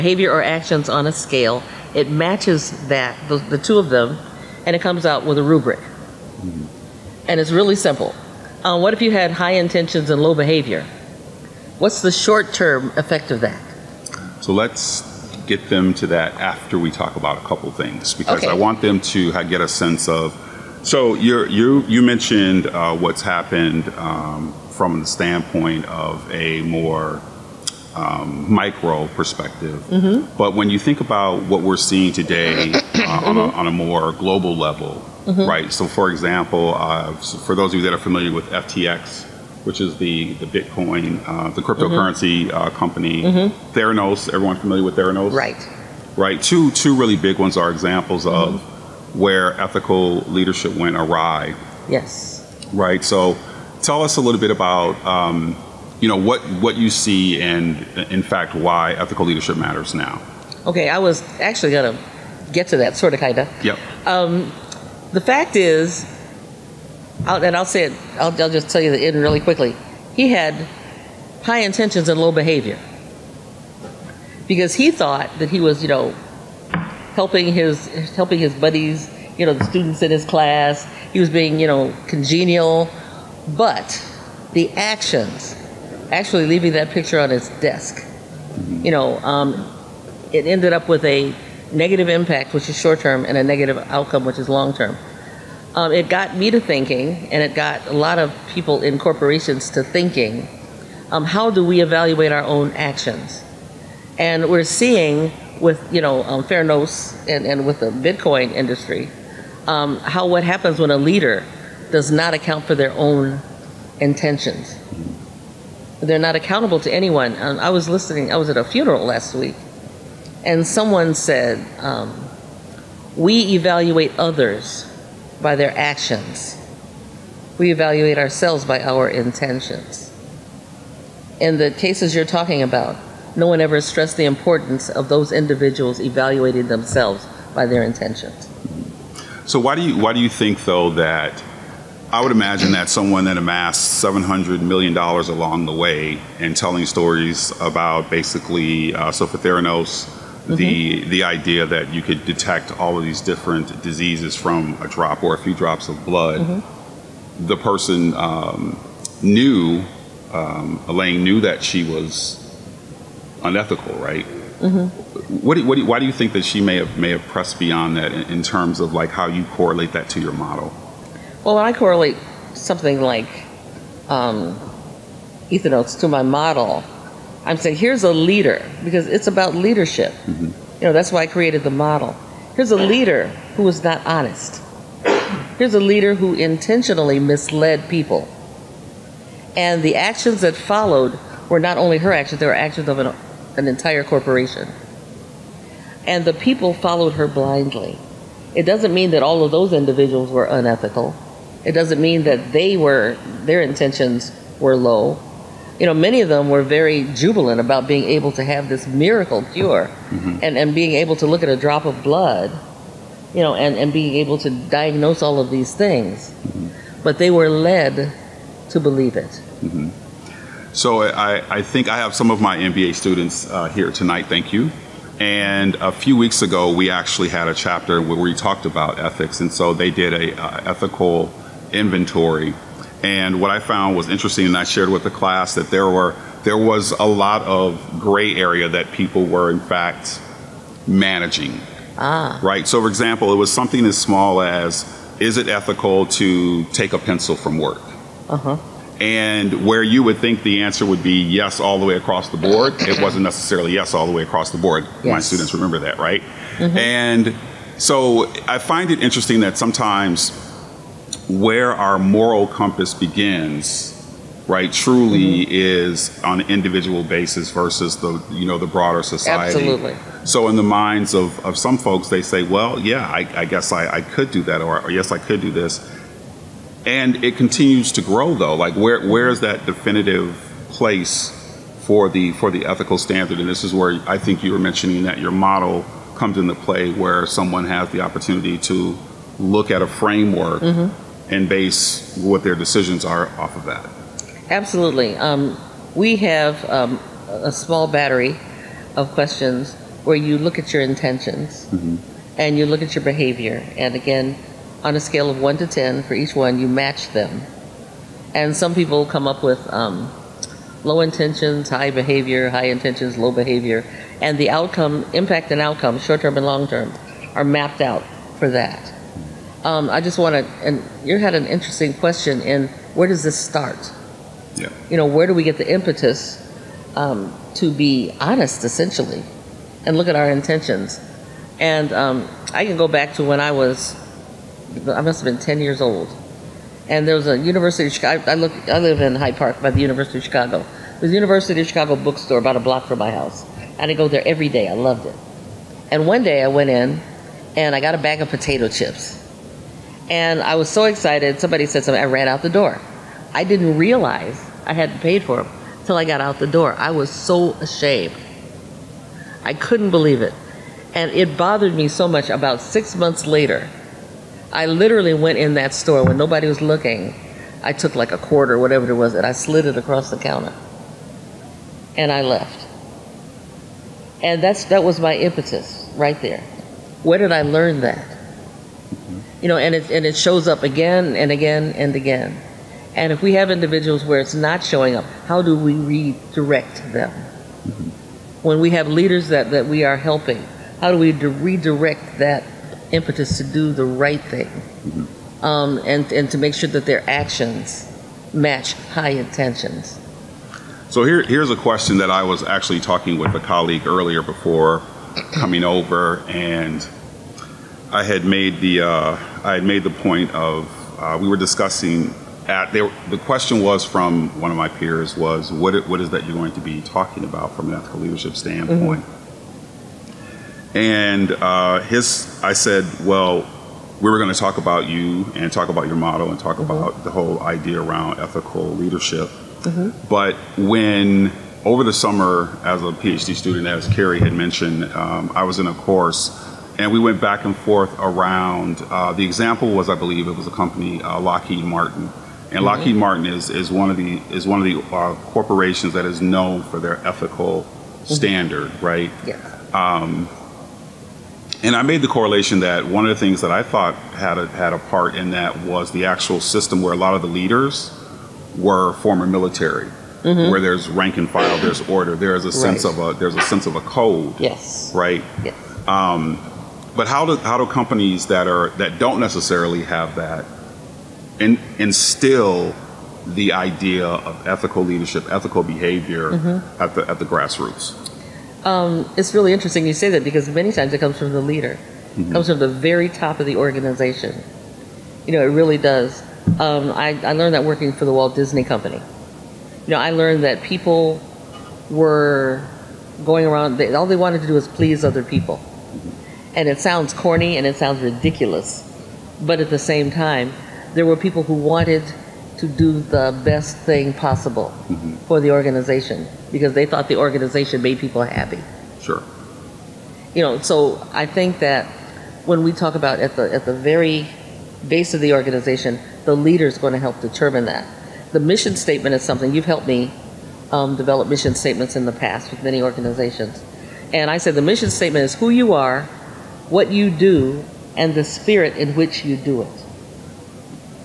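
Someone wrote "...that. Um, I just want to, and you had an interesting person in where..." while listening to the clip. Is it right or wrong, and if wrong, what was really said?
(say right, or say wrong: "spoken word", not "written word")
wrong: "question", not "person".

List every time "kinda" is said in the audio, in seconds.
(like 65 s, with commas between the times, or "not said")
63 s.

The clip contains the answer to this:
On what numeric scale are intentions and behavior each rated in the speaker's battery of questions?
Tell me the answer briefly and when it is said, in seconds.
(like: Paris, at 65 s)
1 to 10, at 305 s.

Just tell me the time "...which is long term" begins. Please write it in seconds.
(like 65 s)
94 s.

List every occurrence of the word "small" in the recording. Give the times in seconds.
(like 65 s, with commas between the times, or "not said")
243 s, 297 s.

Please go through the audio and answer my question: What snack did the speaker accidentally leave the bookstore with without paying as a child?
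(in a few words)
Potato chips.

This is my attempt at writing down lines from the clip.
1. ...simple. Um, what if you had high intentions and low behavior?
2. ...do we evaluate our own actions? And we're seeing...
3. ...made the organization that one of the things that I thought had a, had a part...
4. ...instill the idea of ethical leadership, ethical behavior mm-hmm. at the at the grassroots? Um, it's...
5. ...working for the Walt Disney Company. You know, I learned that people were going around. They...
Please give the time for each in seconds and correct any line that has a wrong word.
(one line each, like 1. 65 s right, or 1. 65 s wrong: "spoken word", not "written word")
1. 7 s right
2. 101 s right
3. 451 s wrong: "correlation", not "organization"
4. 471 s right
5. 487 s right.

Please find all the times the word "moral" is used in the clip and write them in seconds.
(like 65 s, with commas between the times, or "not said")
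261 s.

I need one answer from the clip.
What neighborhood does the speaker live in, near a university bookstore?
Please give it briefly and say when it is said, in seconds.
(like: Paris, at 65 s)
Hyde Park, at 339 s.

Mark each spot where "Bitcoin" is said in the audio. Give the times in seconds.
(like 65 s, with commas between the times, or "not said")
40 s, 107 s.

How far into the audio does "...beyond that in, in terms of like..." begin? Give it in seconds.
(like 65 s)
167 s.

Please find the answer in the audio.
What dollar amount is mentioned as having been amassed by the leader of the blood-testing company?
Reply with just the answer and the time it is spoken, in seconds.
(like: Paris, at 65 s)
$700 million, at 144 s.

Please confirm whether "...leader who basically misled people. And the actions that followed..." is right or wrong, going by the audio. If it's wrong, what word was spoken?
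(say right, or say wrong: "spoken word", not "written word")
wrong: "intentionally", not "basically".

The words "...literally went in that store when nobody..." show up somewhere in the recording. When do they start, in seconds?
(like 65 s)
364 s.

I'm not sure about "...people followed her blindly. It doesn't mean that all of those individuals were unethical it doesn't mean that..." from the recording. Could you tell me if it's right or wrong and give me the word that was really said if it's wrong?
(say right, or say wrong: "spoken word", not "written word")
right.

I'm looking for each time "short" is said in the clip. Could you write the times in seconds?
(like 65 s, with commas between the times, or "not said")
12 s, 92 s, 315 s.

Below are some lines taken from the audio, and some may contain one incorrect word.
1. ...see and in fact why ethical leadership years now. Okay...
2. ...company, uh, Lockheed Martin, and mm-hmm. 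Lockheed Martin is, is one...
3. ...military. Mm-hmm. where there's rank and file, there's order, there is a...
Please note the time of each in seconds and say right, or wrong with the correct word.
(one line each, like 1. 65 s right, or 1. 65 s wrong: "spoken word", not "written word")
1. 56 s wrong: "matters", not "years"
2. 440 s right
3. 459 s right.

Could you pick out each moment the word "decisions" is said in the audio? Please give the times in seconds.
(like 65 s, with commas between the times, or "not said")
292 s.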